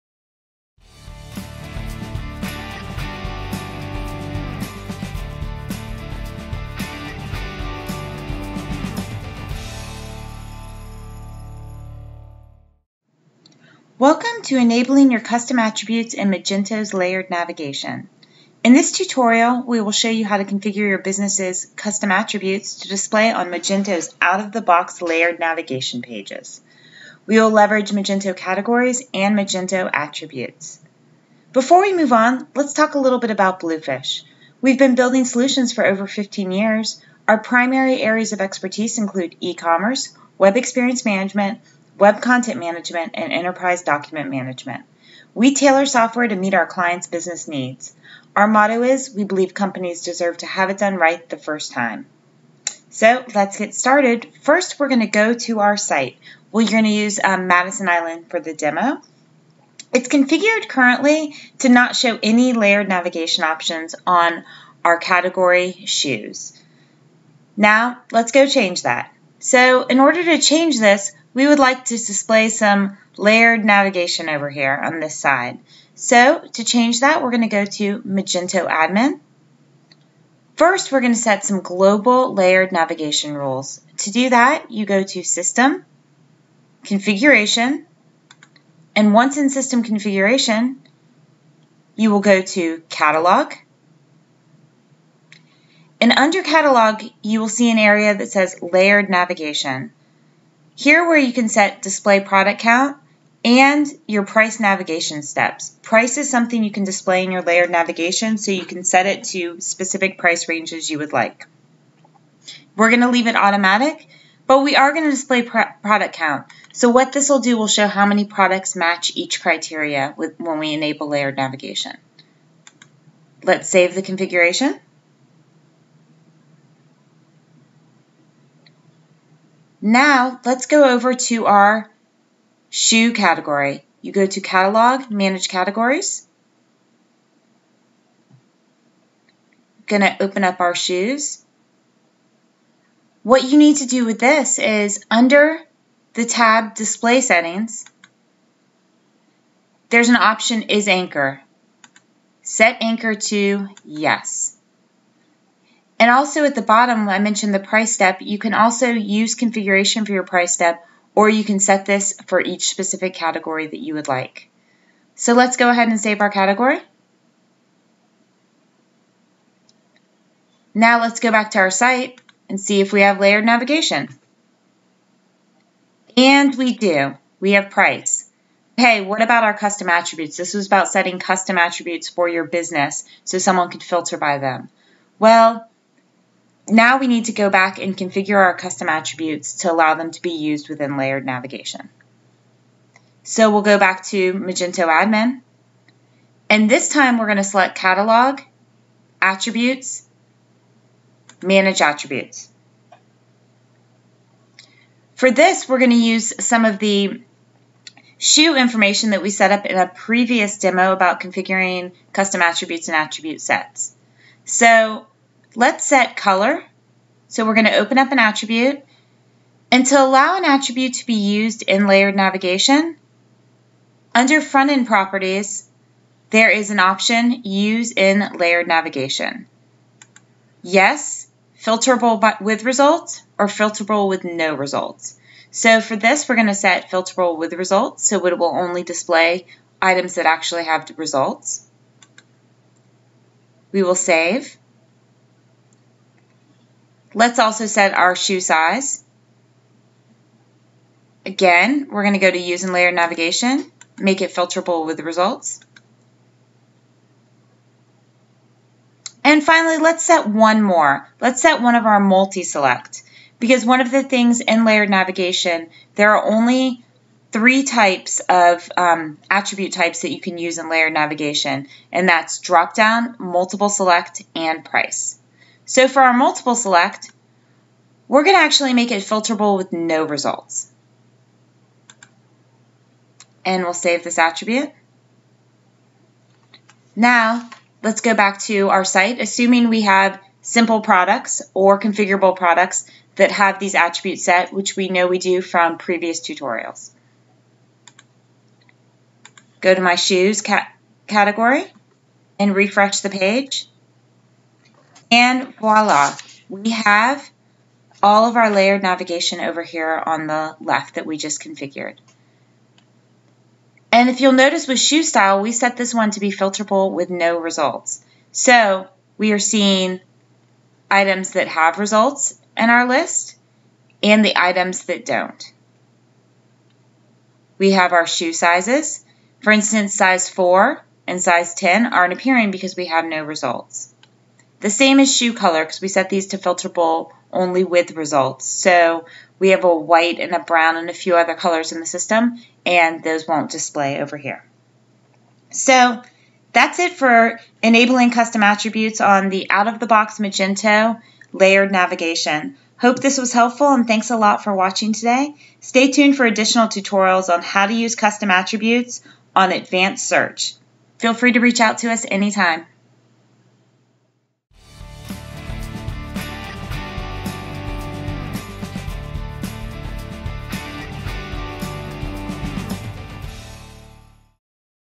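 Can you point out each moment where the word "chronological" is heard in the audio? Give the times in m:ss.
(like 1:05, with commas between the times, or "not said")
not said.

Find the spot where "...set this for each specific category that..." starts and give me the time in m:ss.
2:41.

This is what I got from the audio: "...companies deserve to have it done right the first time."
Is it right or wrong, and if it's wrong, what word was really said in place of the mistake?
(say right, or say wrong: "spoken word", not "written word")
right.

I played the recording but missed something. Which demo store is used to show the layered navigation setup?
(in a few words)
Madison Island.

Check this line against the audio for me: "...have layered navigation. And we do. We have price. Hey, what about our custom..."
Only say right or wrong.
right.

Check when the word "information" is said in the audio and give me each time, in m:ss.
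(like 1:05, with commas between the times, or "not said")
3:28.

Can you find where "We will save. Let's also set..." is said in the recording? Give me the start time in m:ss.
4:03.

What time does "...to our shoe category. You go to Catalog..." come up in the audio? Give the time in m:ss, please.
2:11.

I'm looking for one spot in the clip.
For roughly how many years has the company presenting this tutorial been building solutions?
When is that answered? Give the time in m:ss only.
0:36.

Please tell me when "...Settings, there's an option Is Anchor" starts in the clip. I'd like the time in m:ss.
2:27.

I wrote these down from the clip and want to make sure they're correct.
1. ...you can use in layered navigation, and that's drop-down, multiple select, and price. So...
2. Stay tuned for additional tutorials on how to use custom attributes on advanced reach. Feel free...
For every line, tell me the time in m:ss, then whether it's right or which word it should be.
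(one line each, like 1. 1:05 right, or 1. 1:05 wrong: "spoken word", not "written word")
1. 4:30 right
2. 5:55 wrong: "search", not "reach".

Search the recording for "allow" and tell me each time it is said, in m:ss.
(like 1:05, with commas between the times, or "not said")
3:09, 3:40.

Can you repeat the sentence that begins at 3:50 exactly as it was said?
Yes, filterable by, with results or filterable with no results.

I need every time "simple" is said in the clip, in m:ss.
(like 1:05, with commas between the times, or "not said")
4:50.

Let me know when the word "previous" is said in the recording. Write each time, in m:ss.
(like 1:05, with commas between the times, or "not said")
3:29, 4:55.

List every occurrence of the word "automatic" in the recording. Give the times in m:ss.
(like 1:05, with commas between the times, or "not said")
1:53.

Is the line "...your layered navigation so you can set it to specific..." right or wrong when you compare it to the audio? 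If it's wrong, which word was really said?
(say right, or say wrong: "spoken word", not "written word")
right.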